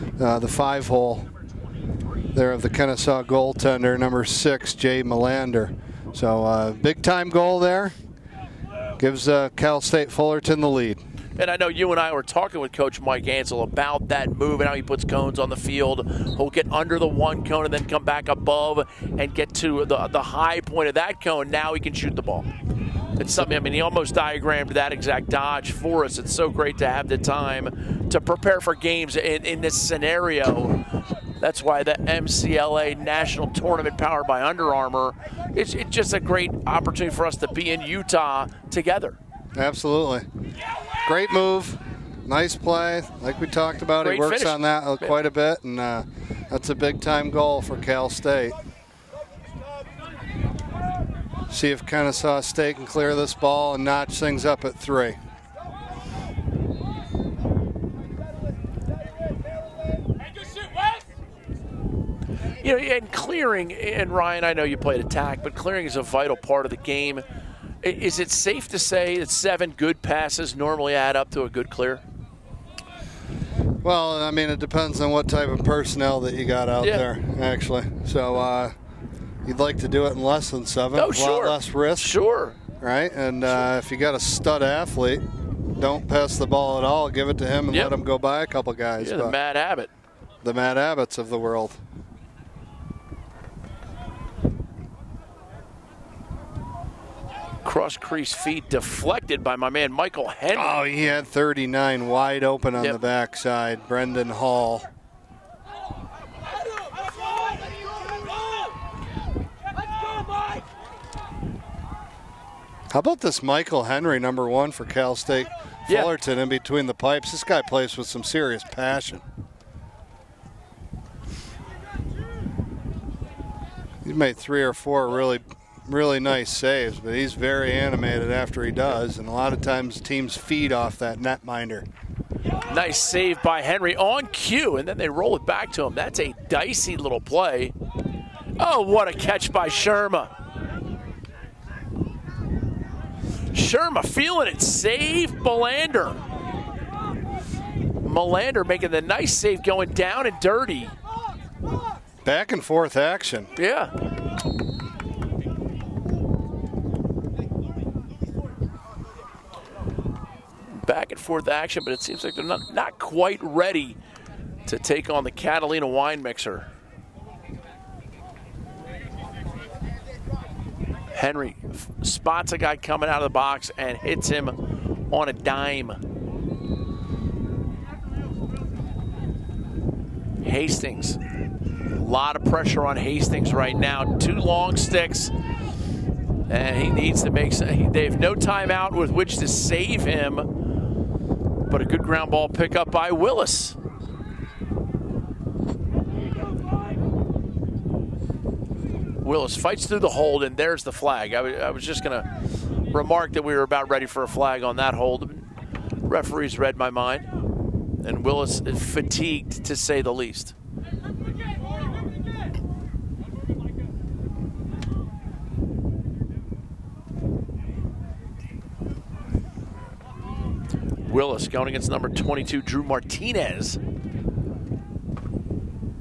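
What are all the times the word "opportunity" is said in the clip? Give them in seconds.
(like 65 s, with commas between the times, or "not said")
36 s.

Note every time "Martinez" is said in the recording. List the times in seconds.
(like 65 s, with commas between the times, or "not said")
222 s.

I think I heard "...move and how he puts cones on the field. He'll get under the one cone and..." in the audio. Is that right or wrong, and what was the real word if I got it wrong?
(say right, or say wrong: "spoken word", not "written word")
right.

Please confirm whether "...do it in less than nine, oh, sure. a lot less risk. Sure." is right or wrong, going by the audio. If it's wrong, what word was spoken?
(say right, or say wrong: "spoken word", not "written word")
wrong: "seven", not "nine".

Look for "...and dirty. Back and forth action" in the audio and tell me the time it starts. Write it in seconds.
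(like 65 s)
150 s.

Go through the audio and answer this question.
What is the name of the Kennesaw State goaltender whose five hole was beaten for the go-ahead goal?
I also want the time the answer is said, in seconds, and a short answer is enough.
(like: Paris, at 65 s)
Jay Melander, at 4 s.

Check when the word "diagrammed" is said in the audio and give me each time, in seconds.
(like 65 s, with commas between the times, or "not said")
24 s.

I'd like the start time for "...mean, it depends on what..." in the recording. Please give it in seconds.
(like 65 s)
74 s.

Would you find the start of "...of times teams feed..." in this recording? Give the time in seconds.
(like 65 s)
129 s.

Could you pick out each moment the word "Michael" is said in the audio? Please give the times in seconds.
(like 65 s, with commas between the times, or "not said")
99 s, 113 s.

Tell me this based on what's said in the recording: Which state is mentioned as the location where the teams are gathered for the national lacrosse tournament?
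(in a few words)
Utah.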